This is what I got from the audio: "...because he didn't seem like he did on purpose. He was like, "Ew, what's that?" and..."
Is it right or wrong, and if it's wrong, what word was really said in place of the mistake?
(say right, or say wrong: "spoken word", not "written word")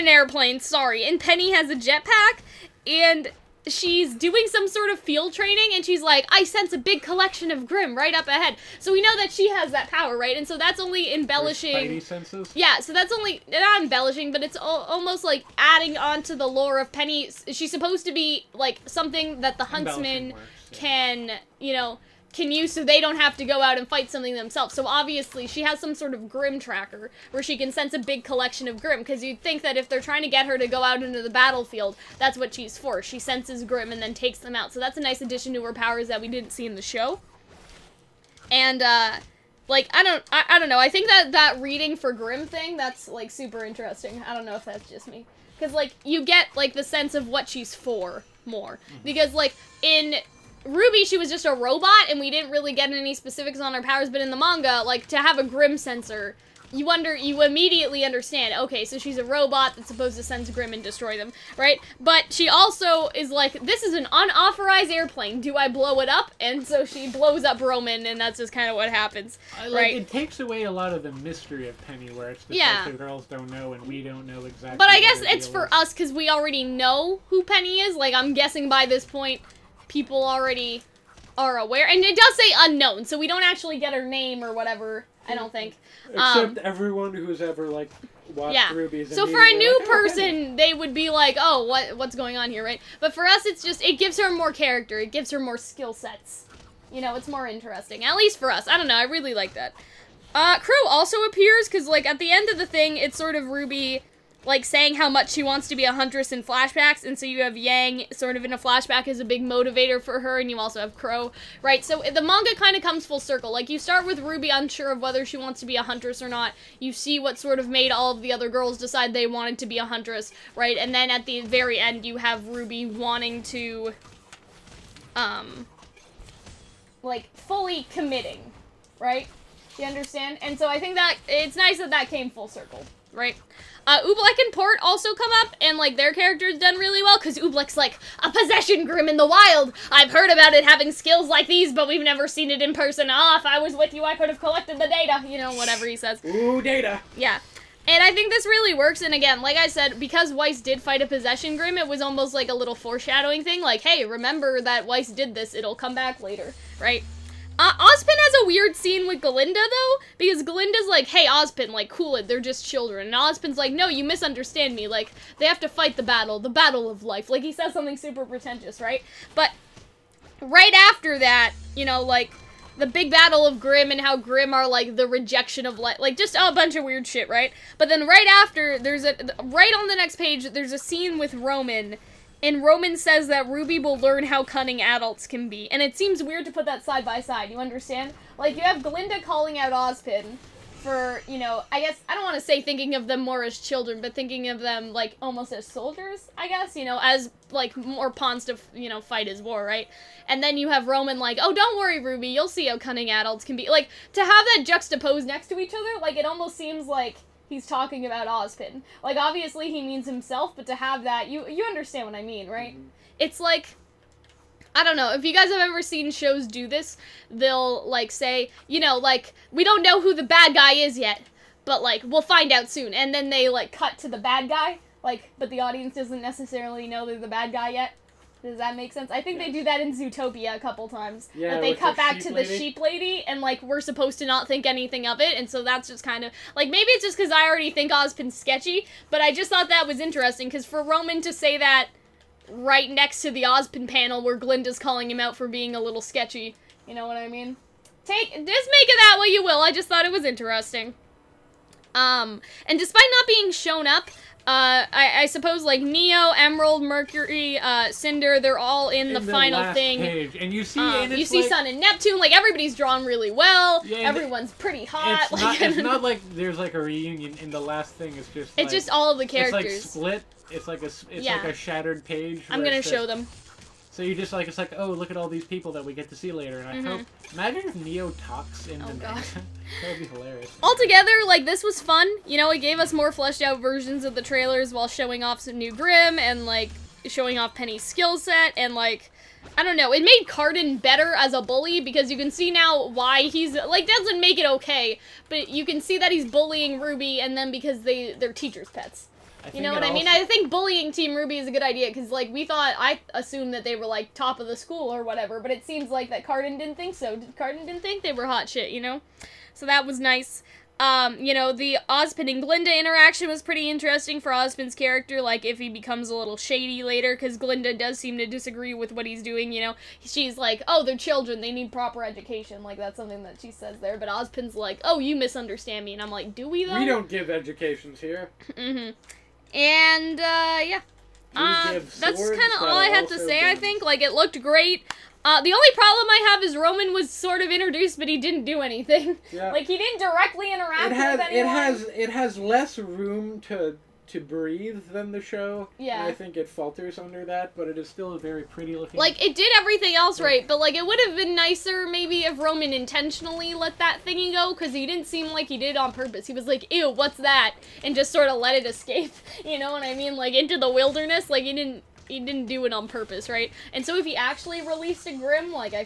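right.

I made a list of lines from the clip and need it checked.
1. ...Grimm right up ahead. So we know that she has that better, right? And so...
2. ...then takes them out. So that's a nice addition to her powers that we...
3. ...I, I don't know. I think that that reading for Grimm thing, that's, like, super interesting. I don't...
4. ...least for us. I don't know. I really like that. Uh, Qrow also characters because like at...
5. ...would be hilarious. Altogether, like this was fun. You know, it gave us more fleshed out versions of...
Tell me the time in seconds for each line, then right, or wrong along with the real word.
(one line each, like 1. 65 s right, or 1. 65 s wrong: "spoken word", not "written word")
1. 7 s wrong: "power", not "better"
2. 34 s right
3. 40 s right
4. 98 s wrong: "appears", not "characters"
5. 279 s right.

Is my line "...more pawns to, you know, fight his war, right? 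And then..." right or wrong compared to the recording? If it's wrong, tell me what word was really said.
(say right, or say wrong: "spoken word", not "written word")
right.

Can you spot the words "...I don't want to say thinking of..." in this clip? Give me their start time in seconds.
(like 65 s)
192 s.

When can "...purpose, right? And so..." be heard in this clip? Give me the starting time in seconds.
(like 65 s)
362 s.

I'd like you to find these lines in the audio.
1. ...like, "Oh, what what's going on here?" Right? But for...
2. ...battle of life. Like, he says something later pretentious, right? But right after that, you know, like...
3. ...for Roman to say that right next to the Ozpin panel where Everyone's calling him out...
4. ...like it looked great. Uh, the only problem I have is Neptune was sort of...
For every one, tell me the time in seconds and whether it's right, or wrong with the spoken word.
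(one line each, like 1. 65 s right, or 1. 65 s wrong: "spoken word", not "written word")
1. 91 s right
2. 166 s wrong: "super", not "later"
3. 240 s wrong: "Glynda", not "Everyone"
4. 333 s wrong: "Roman", not "Neptune".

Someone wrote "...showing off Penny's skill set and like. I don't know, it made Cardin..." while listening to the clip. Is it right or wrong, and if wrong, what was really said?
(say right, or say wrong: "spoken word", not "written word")
right.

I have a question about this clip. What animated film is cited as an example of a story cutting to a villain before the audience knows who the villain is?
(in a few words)
Zootopia.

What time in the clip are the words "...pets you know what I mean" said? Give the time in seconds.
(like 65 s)
298 s.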